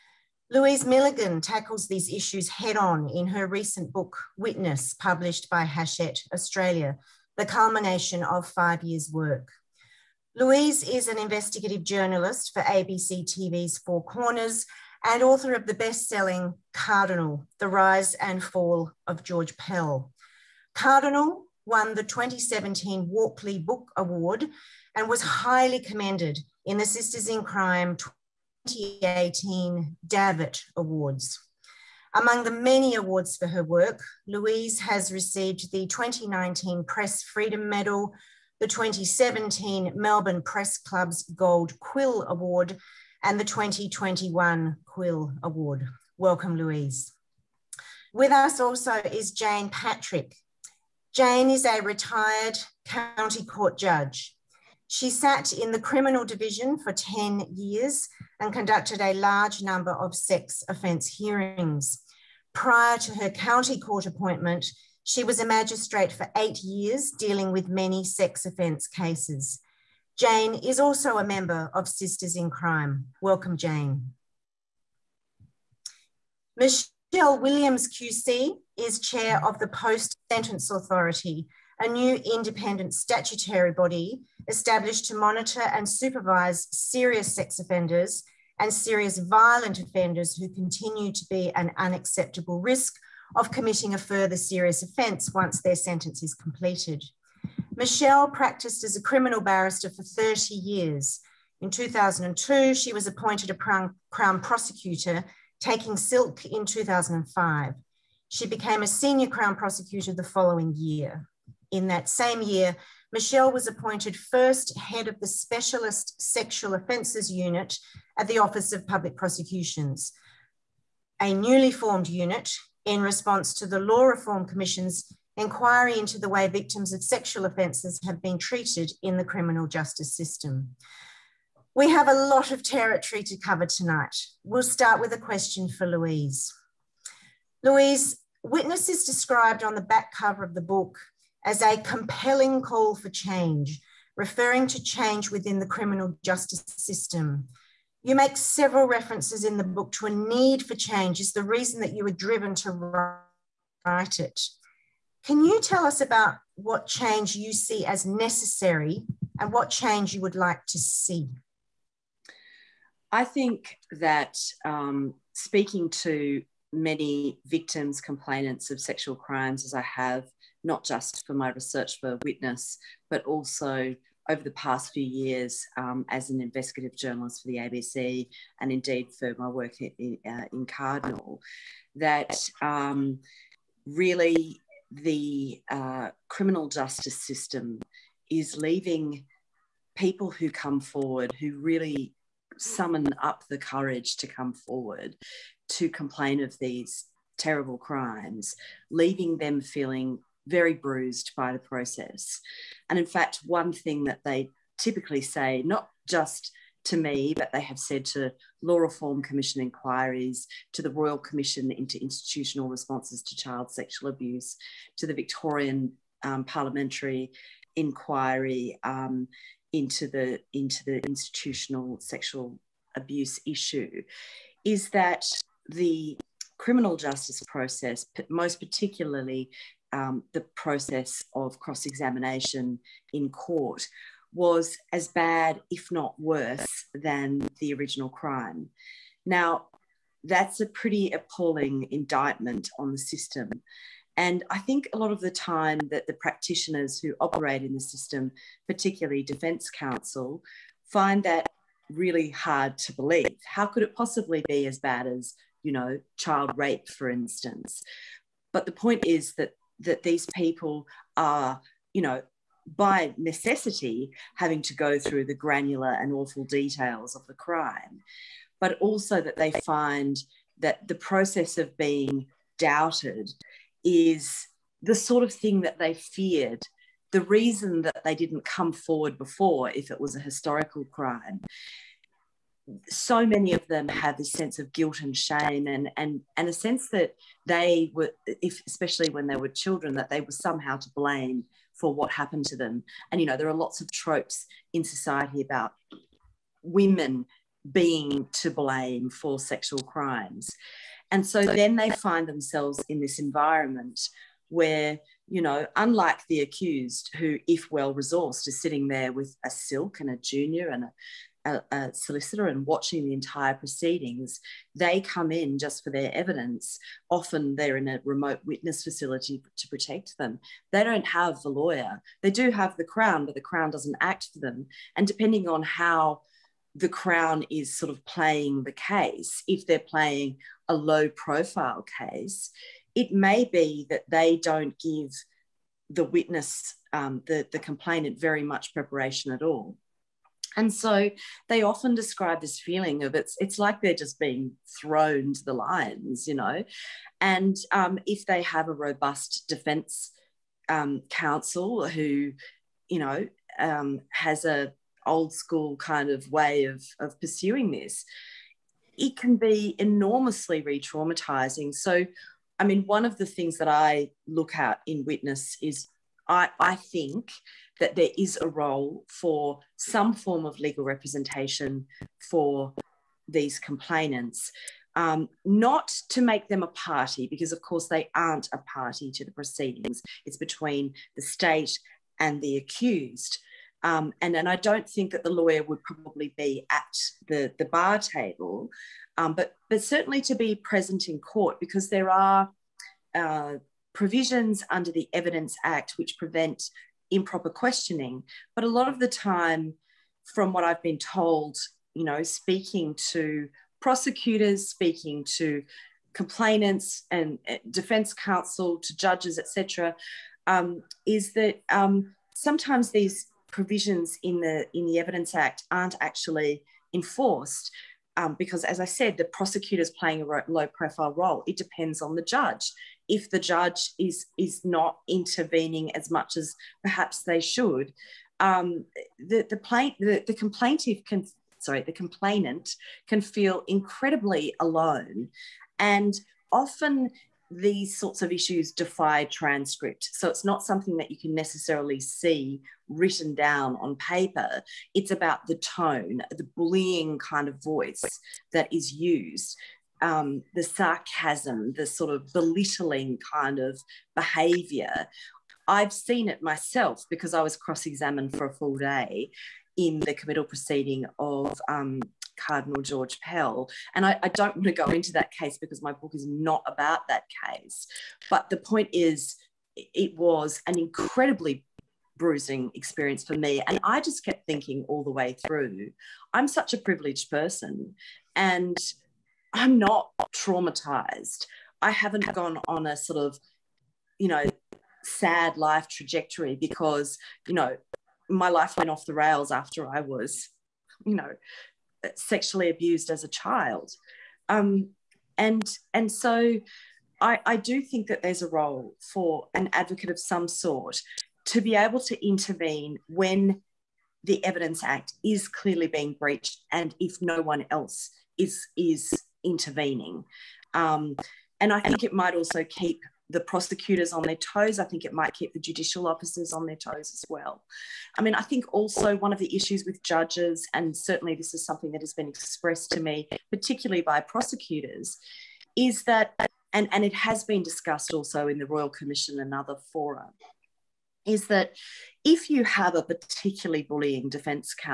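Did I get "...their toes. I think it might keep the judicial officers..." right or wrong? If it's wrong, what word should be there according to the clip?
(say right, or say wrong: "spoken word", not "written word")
right.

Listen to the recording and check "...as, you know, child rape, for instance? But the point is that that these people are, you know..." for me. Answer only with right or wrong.
right.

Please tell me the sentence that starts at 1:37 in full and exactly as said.
Michele practiced as a criminal barrister for 30 years.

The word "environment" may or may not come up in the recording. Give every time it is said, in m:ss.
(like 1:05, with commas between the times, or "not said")
5:03.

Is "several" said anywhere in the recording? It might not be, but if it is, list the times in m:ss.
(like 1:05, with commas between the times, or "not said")
2:28.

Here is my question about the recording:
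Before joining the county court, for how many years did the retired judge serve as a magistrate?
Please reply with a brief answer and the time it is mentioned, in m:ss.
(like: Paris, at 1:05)
8, at 1:06.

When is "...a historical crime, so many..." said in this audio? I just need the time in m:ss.
4:40.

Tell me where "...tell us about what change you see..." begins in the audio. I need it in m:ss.
2:35.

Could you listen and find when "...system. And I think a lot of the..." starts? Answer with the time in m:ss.
4:02.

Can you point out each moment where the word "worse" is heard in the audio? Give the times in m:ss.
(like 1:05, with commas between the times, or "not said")
3:56.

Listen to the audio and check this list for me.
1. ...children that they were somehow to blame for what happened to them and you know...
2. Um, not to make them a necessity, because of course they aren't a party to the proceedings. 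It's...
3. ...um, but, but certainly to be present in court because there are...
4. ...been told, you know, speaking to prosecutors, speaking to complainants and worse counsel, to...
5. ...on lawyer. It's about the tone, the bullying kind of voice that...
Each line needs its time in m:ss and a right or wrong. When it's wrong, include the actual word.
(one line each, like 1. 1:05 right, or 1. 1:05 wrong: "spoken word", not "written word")
1. 4:49 right
2. 6:14 wrong: "party", not "necessity"
3. 6:29 right
4. 6:40 wrong: "defense", not "worse"
5. 7:23 wrong: "paper", not "lawyer".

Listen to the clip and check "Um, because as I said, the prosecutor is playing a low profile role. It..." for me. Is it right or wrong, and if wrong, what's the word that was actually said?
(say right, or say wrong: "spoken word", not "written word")
right.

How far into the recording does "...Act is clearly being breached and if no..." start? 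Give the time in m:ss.
8:24.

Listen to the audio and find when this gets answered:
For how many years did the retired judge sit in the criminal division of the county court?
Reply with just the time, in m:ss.
0:56.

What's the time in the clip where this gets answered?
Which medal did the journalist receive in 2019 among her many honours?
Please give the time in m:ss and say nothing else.
0:36.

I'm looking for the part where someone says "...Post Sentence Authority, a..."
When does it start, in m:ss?
1:19.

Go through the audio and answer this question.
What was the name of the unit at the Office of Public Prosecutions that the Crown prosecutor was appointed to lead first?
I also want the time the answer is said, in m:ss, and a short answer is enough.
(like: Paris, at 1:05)
Specialist Sexual Offences Unit, at 1:55.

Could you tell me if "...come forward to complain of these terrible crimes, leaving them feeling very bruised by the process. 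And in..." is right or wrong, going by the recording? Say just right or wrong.
right.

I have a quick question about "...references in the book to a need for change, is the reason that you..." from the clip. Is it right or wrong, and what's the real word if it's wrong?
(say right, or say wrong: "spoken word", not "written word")
right.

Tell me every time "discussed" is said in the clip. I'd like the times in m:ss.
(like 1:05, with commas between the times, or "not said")
8:47.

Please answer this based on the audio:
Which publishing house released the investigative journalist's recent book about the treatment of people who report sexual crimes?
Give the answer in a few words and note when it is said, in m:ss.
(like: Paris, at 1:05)
Hachette Australia, at 0:05.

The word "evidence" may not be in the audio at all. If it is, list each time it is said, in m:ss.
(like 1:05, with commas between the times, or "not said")
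5:16, 6:35, 6:54, 8:24.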